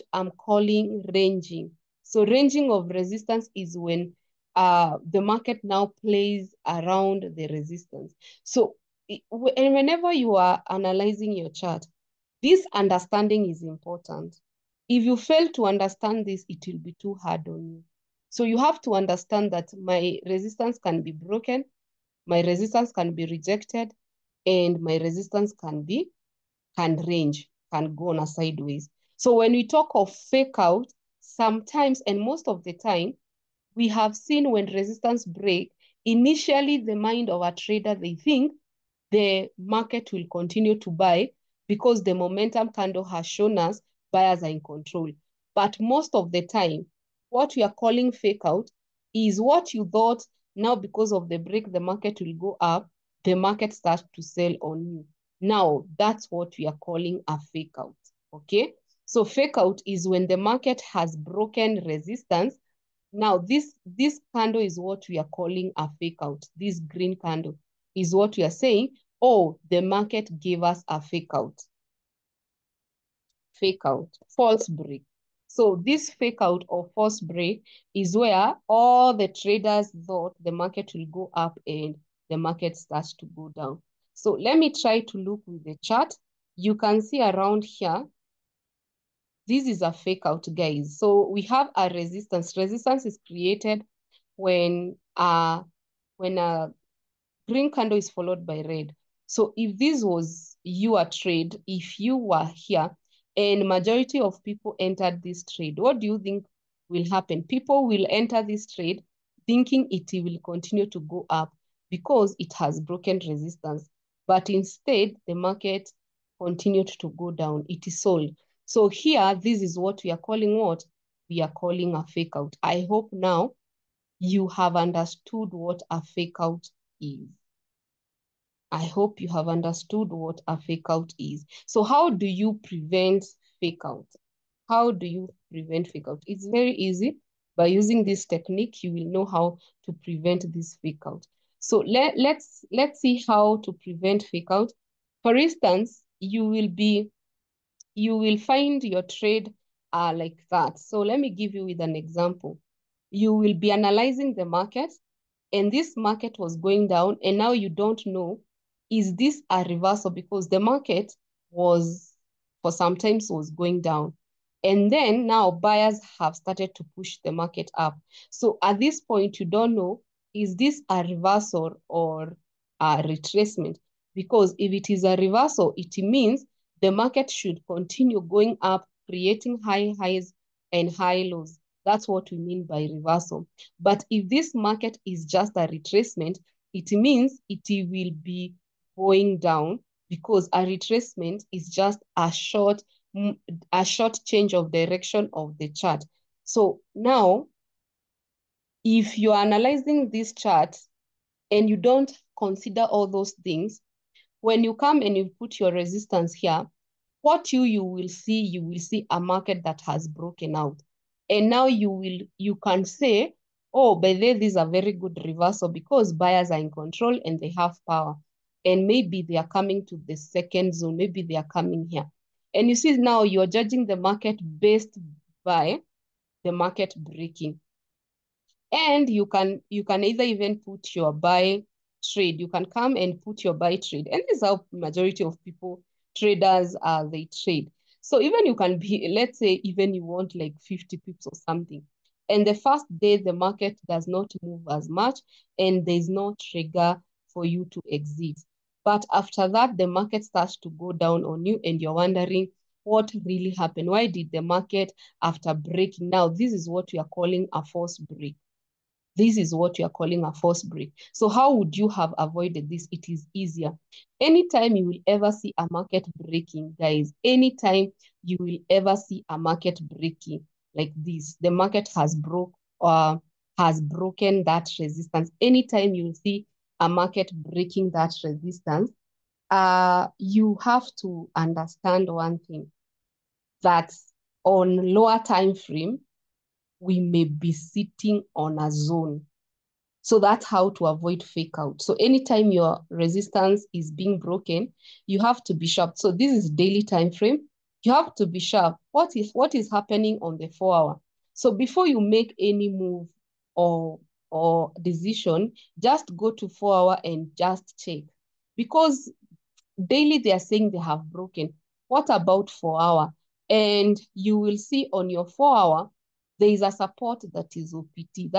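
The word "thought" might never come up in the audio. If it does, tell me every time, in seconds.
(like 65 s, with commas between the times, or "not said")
49 s, 80 s.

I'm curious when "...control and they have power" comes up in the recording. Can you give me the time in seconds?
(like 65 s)
216 s.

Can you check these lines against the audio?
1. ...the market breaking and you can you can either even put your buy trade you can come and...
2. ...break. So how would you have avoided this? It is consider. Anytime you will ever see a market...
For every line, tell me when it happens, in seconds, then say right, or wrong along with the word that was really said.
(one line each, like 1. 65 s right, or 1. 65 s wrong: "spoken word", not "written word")
1. 226 s right
2. 260 s wrong: "easier", not "consider".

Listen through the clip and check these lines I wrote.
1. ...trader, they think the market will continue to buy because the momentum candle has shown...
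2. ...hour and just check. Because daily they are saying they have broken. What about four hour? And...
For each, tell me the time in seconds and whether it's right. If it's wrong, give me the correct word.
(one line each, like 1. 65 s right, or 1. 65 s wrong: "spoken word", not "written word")
1. 37 s right
2. 306 s right.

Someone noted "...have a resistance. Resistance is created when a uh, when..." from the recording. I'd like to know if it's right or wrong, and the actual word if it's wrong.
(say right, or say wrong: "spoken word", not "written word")
right.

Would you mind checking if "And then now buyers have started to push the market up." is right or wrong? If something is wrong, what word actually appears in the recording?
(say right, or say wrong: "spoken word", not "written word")
right.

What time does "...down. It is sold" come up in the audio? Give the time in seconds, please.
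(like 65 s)
117 s.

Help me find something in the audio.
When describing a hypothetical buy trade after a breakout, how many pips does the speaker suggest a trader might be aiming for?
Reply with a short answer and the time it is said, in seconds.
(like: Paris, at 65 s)
50 pips, at 240 s.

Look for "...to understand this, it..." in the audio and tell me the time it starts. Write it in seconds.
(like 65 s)
15 s.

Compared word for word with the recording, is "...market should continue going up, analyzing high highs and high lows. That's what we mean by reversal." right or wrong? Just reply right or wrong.
wrong.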